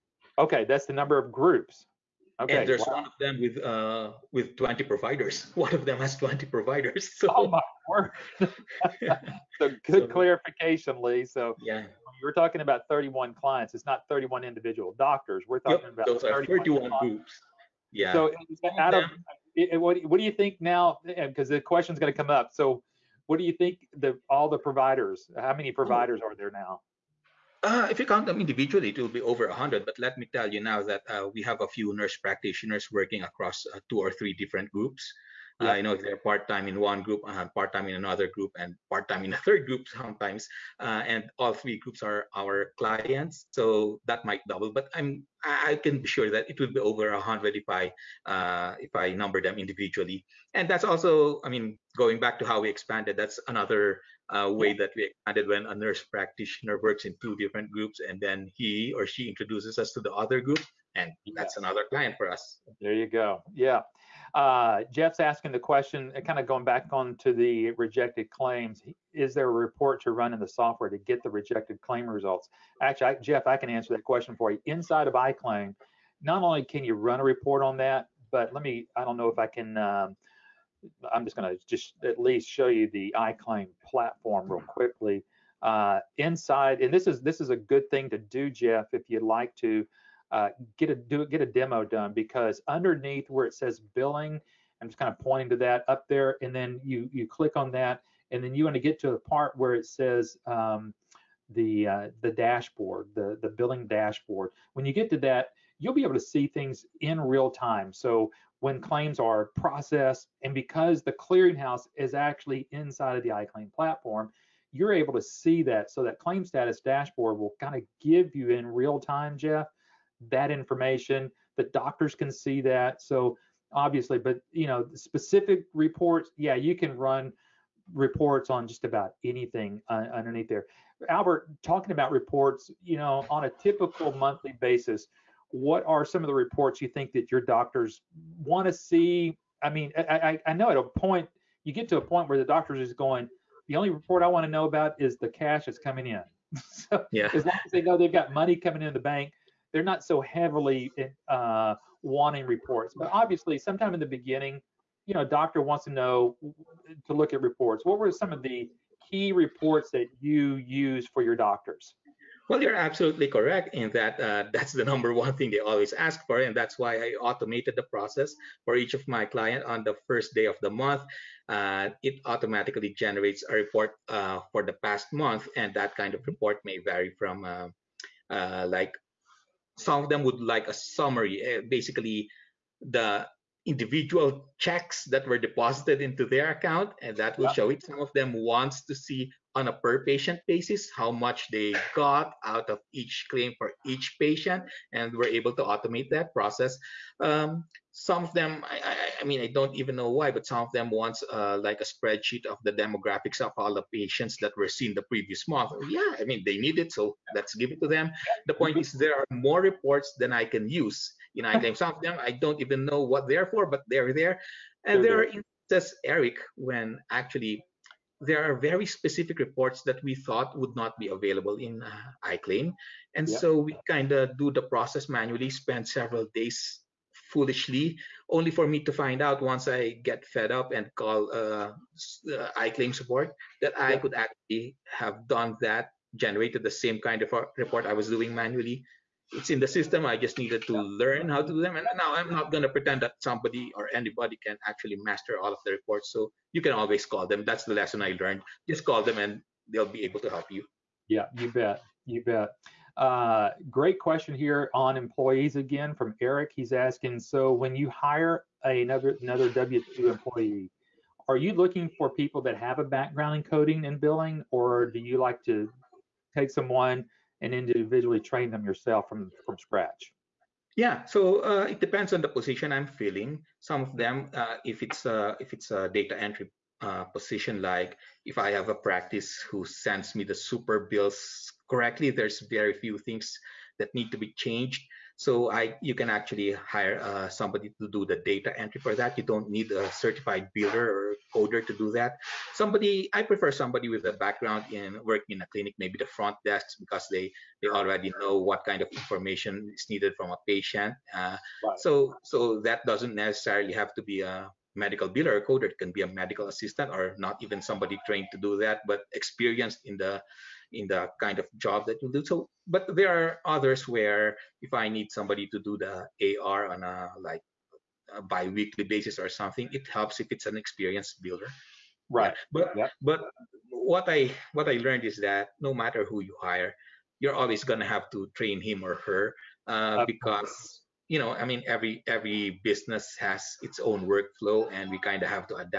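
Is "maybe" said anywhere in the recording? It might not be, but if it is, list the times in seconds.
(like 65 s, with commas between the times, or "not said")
295 s.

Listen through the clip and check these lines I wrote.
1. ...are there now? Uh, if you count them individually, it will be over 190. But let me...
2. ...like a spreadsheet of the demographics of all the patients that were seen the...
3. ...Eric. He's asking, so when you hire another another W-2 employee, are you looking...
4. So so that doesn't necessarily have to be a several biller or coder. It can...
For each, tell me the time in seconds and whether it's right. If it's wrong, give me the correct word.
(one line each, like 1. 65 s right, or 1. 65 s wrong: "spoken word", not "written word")
1. 26 s wrong: "100", not "190"
2. 201 s right
3. 256 s right
4. 301 s wrong: "medical", not "several".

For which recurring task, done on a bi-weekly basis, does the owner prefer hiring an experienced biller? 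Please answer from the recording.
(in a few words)
AR.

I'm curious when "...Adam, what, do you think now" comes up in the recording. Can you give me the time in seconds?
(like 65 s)
18 s.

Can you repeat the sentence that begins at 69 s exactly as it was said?
Is there a report to run in the software to get the rejected claim results?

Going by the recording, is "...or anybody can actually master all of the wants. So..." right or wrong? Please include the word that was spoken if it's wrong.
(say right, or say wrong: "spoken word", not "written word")
wrong: "reports", not "wants".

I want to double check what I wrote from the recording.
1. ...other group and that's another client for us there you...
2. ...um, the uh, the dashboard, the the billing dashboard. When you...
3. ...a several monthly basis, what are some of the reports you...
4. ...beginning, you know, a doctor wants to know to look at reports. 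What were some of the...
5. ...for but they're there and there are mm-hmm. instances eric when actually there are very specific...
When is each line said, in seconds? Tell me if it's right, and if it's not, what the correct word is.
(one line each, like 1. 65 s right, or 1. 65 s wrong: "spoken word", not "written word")
1. 60 s right
2. 100 s right
3. 133 s wrong: "typical", not "several"
4. 154 s right
5. 213 s right.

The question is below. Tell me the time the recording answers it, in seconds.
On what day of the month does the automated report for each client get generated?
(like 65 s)
170 s.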